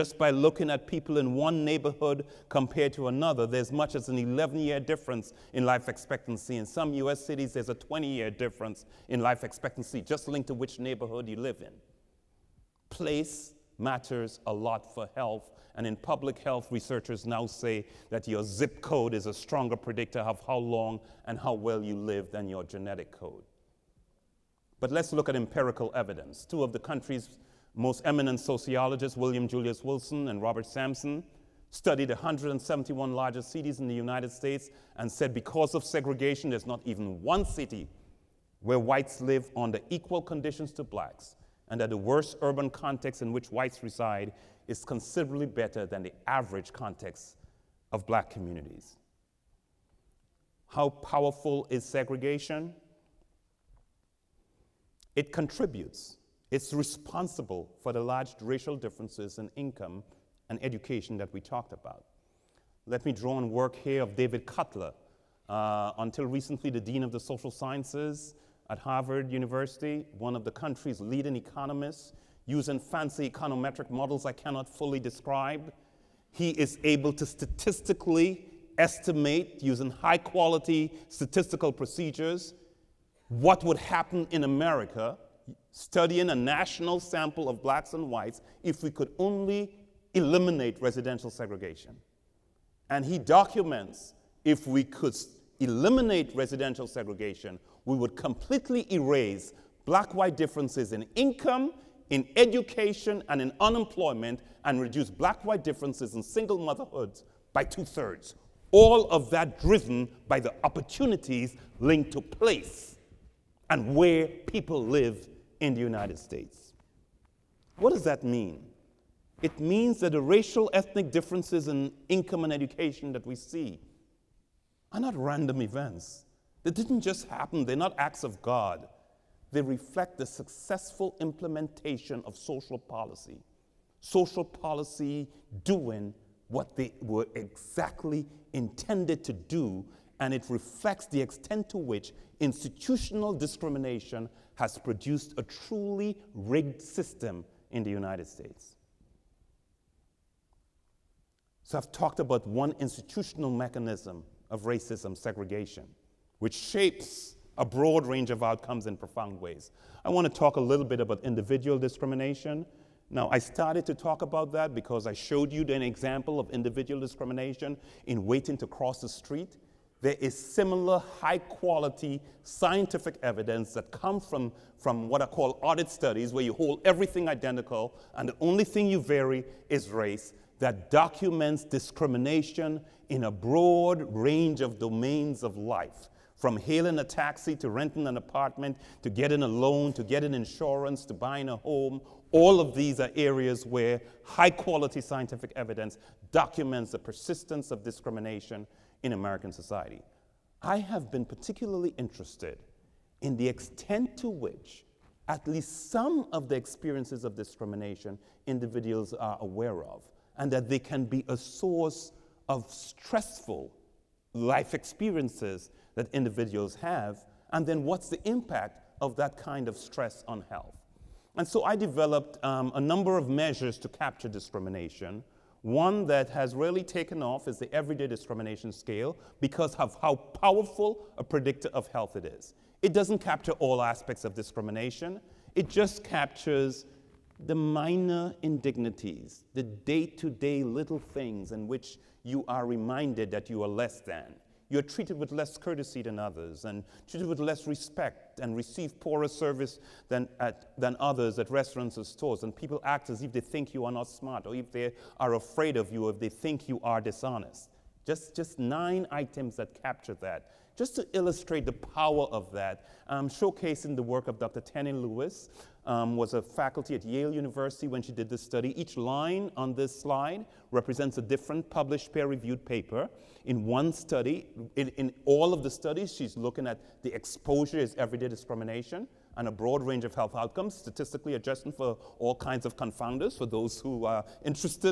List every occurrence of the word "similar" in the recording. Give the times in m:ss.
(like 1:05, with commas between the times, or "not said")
2:50.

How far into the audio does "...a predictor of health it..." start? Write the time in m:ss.
3:51.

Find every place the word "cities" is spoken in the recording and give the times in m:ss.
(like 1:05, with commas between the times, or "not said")
0:07, 0:33.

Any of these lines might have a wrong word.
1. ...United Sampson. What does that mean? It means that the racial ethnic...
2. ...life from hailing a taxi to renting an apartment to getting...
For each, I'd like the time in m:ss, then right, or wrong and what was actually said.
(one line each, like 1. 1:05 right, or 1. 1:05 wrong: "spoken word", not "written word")
1. 1:55 wrong: "States", not "Sampson"
2. 3:05 right.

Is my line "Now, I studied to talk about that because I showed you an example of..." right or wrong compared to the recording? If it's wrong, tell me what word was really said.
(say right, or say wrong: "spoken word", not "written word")
wrong: "started", not "studied".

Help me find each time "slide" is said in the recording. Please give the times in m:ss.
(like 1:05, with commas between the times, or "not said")
4:30.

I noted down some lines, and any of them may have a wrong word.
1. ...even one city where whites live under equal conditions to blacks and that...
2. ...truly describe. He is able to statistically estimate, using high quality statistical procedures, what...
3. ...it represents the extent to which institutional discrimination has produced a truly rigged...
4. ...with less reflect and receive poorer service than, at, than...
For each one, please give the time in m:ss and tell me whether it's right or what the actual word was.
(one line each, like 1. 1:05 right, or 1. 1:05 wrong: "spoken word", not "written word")
1. 0:36 right
2. 1:14 wrong: "fully", not "truly"
3. 2:20 wrong: "reflects", not "represents"
4. 4:07 wrong: "respect", not "reflect".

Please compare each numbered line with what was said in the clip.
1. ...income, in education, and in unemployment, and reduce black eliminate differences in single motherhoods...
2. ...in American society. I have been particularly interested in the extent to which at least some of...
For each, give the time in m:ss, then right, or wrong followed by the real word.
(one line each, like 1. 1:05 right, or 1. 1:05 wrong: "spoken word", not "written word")
1. 1:41 wrong: "white", not "eliminate"
2. 3:19 right.